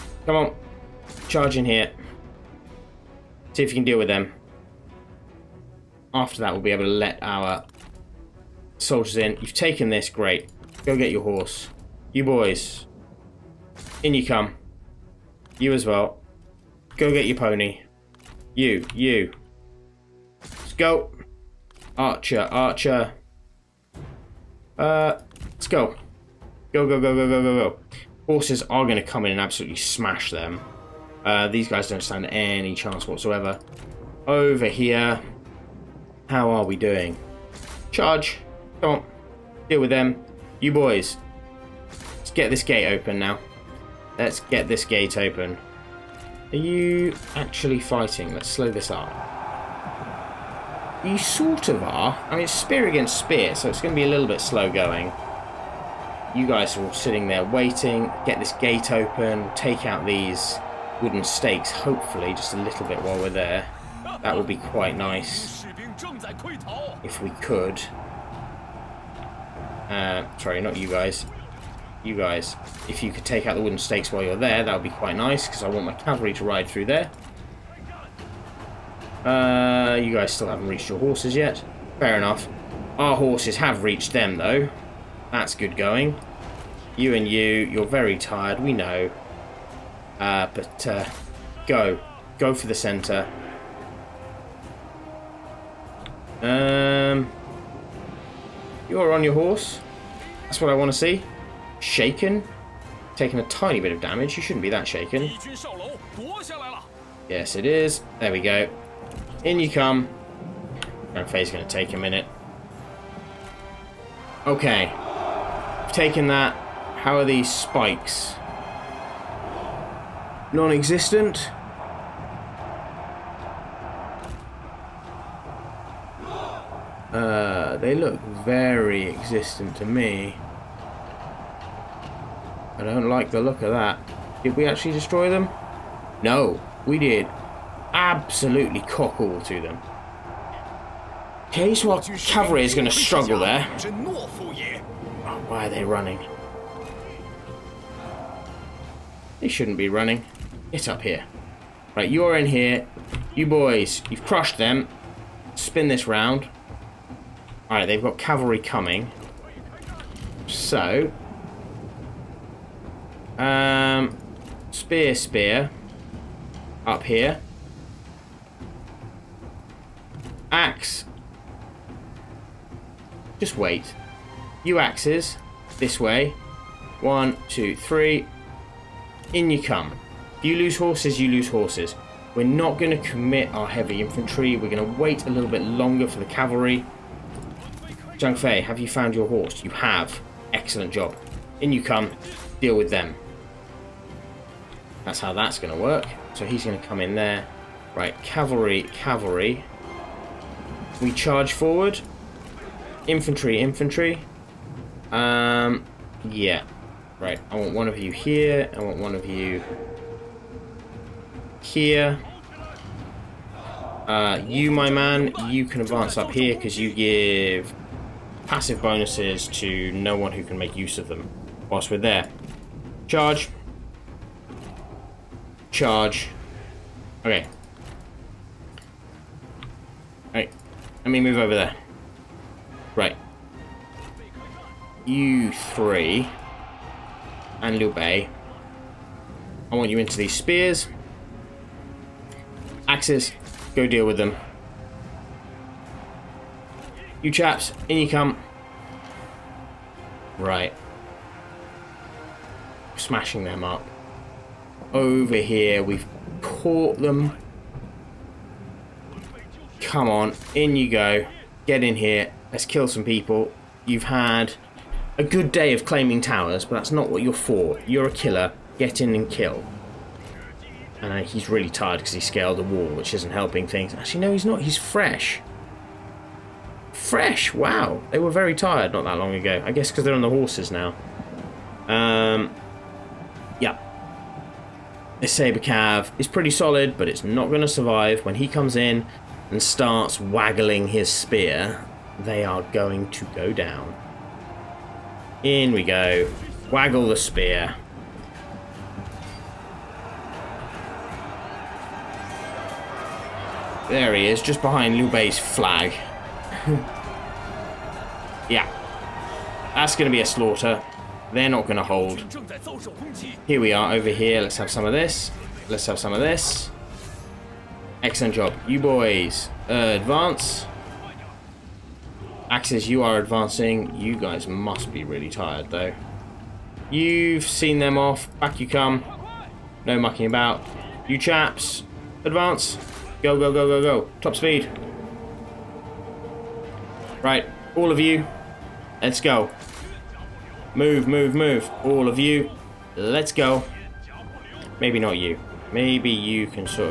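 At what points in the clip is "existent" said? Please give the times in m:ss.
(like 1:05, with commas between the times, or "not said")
2:00, 2:09.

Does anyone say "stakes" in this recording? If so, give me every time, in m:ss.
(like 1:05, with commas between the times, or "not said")
1:01, 1:13.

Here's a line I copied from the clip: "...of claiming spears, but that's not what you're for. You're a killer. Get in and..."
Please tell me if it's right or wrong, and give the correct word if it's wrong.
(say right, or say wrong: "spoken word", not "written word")
wrong: "towers", not "spears".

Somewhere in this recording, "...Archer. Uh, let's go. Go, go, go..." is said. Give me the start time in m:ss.
0:22.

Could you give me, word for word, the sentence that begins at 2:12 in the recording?
I don't like the look of that.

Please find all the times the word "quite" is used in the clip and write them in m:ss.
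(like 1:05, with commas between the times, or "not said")
1:04, 1:14.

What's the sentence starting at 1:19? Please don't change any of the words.
Uh, you guys still haven't reached your horses yet.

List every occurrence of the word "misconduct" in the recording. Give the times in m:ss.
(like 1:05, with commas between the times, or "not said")
not said.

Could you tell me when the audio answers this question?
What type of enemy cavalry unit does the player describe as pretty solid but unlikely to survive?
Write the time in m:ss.
4:45.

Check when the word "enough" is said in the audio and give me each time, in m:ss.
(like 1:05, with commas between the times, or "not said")
1:22.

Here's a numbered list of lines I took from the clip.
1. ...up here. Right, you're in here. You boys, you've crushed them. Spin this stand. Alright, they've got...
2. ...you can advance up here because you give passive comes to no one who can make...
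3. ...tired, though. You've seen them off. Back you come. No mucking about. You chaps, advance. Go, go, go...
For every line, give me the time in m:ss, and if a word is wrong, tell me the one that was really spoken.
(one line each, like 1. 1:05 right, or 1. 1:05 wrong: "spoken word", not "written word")
1. 2:30 wrong: "round", not "stand"
2. 3:35 wrong: "bonuses", not "comes"
3. 5:25 right.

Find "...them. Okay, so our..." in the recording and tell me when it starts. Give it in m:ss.
2:19.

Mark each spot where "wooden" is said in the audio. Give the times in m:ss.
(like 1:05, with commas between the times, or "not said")
1:01, 1:13.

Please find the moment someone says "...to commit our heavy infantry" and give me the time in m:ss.
3:02.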